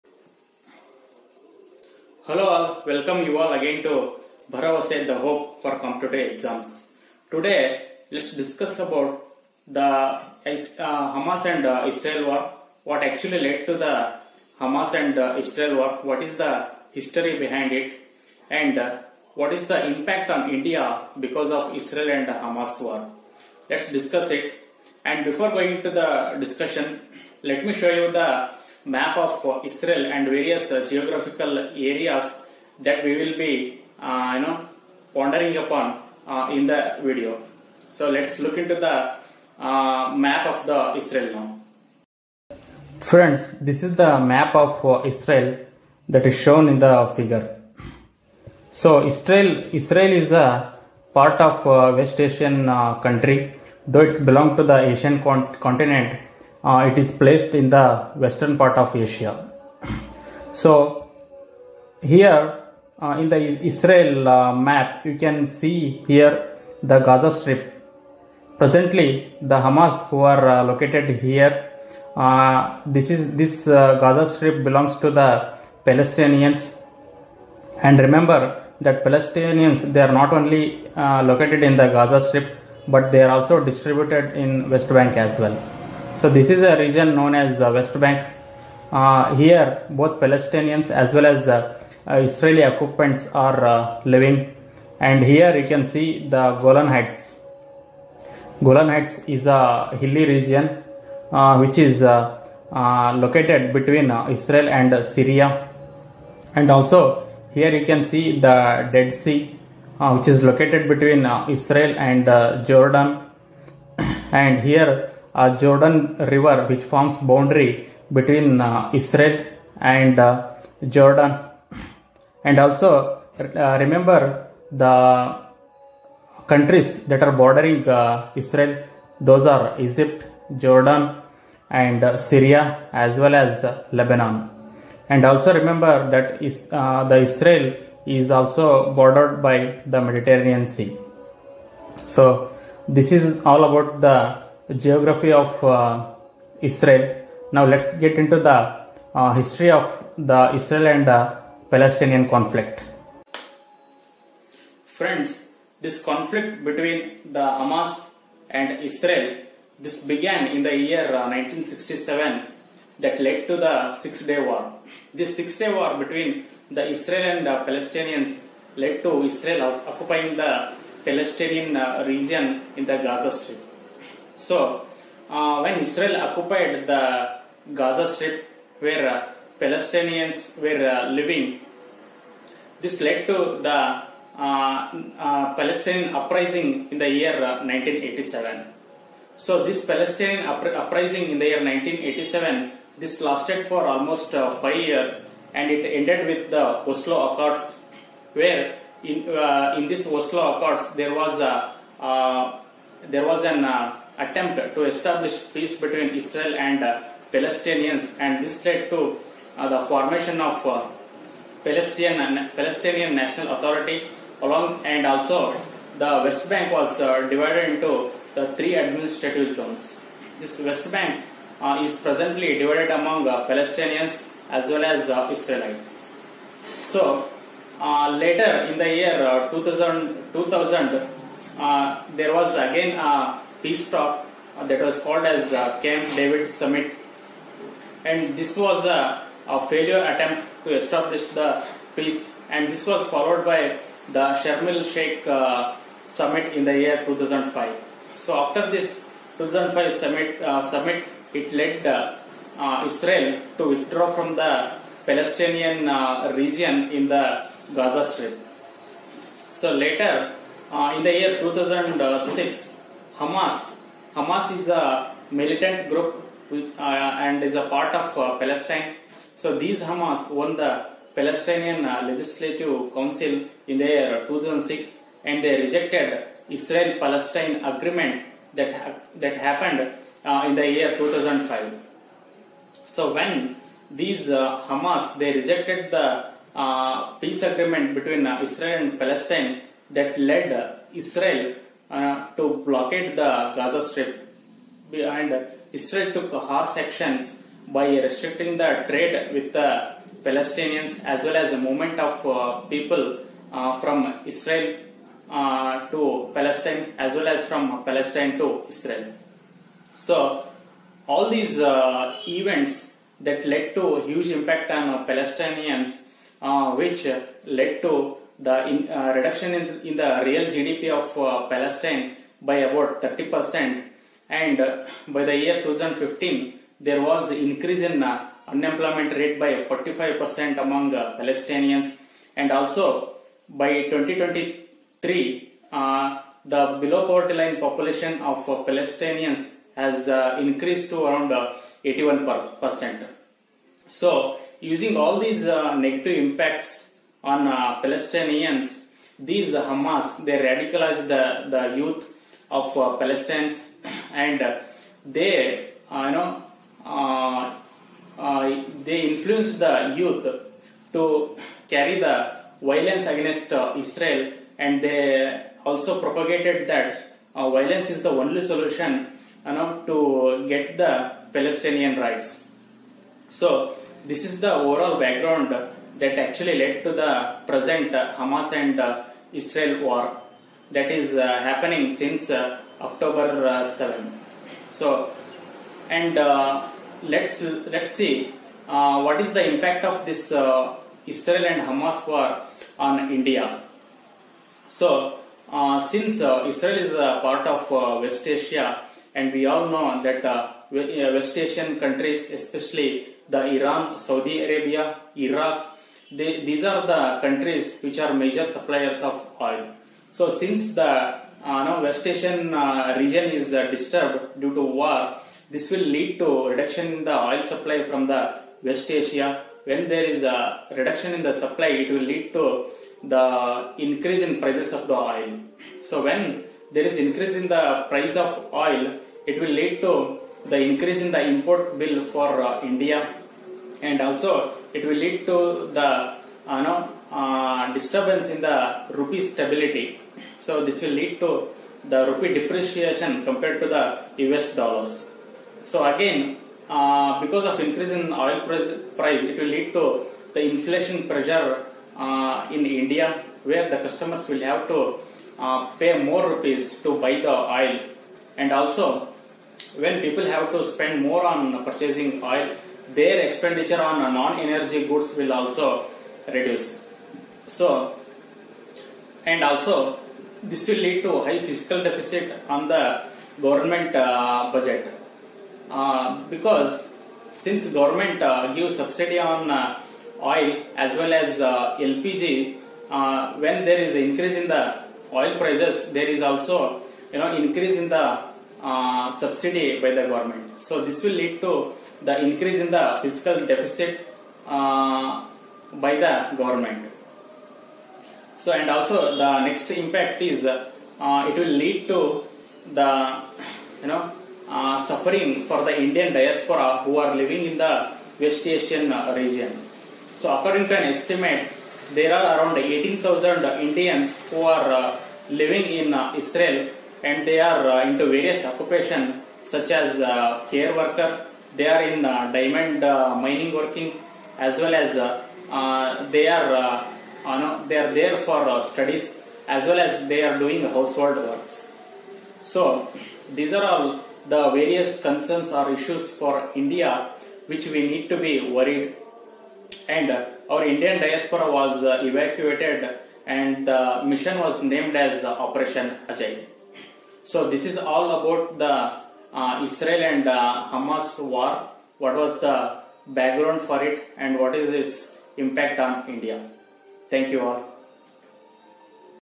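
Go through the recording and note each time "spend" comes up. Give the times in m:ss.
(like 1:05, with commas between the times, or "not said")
7:40.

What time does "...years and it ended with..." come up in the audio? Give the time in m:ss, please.
3:14.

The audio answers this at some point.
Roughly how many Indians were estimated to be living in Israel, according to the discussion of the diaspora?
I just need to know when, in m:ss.
8:32.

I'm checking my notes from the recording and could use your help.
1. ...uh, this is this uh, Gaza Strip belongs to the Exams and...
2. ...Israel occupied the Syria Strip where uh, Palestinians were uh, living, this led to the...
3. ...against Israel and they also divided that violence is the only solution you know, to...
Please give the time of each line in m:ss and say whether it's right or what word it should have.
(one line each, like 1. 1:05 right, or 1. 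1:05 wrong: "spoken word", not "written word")
1. 1:12 wrong: "Palestinians", not "Exams"
2. 2:55 wrong: "Gaza", not "Syria"
3. 6:03 wrong: "propagated", not "divided".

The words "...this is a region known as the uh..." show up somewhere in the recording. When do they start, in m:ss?
1:26.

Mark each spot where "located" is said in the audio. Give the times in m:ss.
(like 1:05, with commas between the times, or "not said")
1:10, 1:21, 1:42, 1:50.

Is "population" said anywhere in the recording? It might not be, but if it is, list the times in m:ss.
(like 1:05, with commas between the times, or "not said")
5:37.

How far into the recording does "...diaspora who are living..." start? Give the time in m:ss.
8:26.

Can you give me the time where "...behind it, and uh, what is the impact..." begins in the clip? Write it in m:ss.
0:17.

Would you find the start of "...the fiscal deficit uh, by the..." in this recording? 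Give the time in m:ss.
8:12.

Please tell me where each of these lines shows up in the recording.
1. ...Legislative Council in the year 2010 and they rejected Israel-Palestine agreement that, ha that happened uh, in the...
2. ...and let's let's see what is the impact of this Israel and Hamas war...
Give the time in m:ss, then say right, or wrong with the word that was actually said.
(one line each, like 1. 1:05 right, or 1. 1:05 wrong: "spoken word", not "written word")
1. 4:32 wrong: "2006", not "2010"
2. 6:25 right.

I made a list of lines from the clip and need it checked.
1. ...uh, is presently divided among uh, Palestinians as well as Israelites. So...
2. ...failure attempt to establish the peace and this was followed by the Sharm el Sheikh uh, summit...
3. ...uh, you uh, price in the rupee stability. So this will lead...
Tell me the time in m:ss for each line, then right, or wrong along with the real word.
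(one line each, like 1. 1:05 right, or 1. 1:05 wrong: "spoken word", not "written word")
1. 3:41 right
2. 3:59 right
3. 7:16 wrong: "disturbance", not "price".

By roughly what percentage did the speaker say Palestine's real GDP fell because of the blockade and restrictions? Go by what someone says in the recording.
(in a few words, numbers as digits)
30%.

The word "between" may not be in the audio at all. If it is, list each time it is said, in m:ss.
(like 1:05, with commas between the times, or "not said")
1:43, 1:50, 1:58, 2:36, 2:45, 3:25, 4:47.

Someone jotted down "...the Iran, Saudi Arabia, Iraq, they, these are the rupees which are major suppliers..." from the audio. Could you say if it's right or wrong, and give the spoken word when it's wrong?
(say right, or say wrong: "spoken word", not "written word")
wrong: "countries", not "rupees".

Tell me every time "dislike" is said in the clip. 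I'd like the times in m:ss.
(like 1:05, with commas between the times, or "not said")
not said.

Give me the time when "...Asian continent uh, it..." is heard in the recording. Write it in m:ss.
0:54.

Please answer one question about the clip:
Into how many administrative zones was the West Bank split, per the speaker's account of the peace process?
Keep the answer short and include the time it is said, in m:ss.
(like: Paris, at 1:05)
3, at 3:38.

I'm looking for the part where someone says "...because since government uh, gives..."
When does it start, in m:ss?
7:56.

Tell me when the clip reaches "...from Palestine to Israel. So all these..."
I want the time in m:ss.
5:07.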